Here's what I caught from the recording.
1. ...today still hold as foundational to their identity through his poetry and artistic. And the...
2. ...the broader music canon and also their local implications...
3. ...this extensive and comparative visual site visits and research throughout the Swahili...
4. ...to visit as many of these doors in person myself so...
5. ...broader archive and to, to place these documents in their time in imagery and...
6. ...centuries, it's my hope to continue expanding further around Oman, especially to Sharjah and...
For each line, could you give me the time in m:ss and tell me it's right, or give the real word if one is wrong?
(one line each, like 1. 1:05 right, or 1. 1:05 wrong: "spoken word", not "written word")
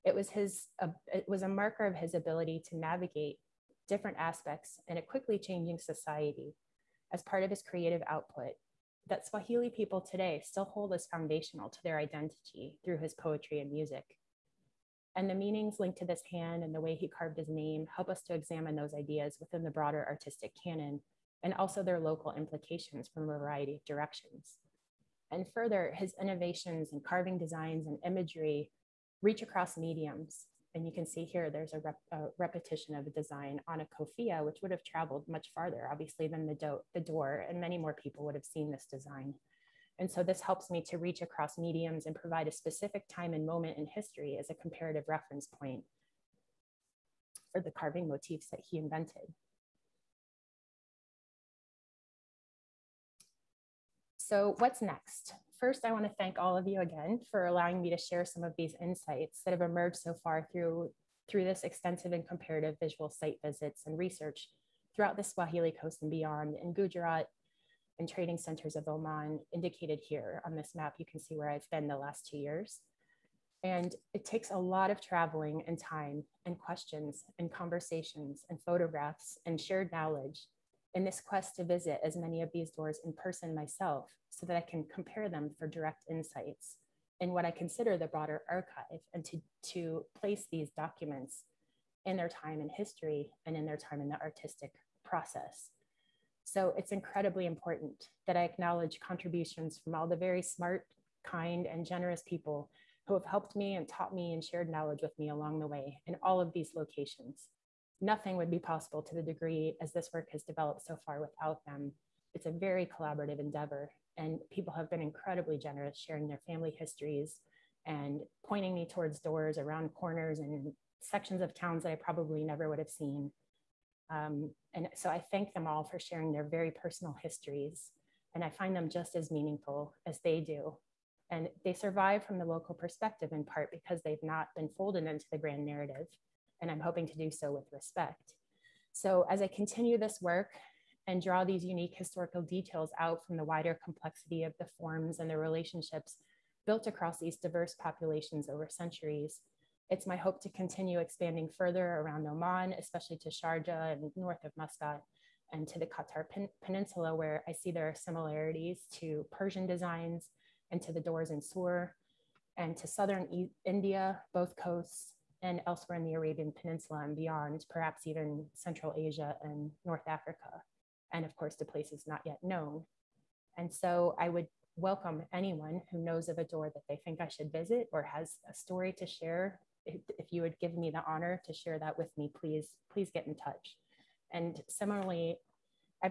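1. 0:09 wrong: "music", not "artistic"
2. 0:19 wrong: "artistic", not "music"
3. 1:01 right
4. 1:21 right
5. 1:28 wrong: "history", not "imagery"
6. 2:28 right.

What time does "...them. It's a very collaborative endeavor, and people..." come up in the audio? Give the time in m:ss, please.
1:51.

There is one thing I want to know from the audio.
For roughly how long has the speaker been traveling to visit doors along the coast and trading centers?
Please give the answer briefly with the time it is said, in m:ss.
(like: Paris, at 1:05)
2 years, at 1:11.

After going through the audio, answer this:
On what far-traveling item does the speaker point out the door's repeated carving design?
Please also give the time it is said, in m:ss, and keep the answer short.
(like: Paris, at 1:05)
Kofia, at 0:33.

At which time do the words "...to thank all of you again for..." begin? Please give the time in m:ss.
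0:56.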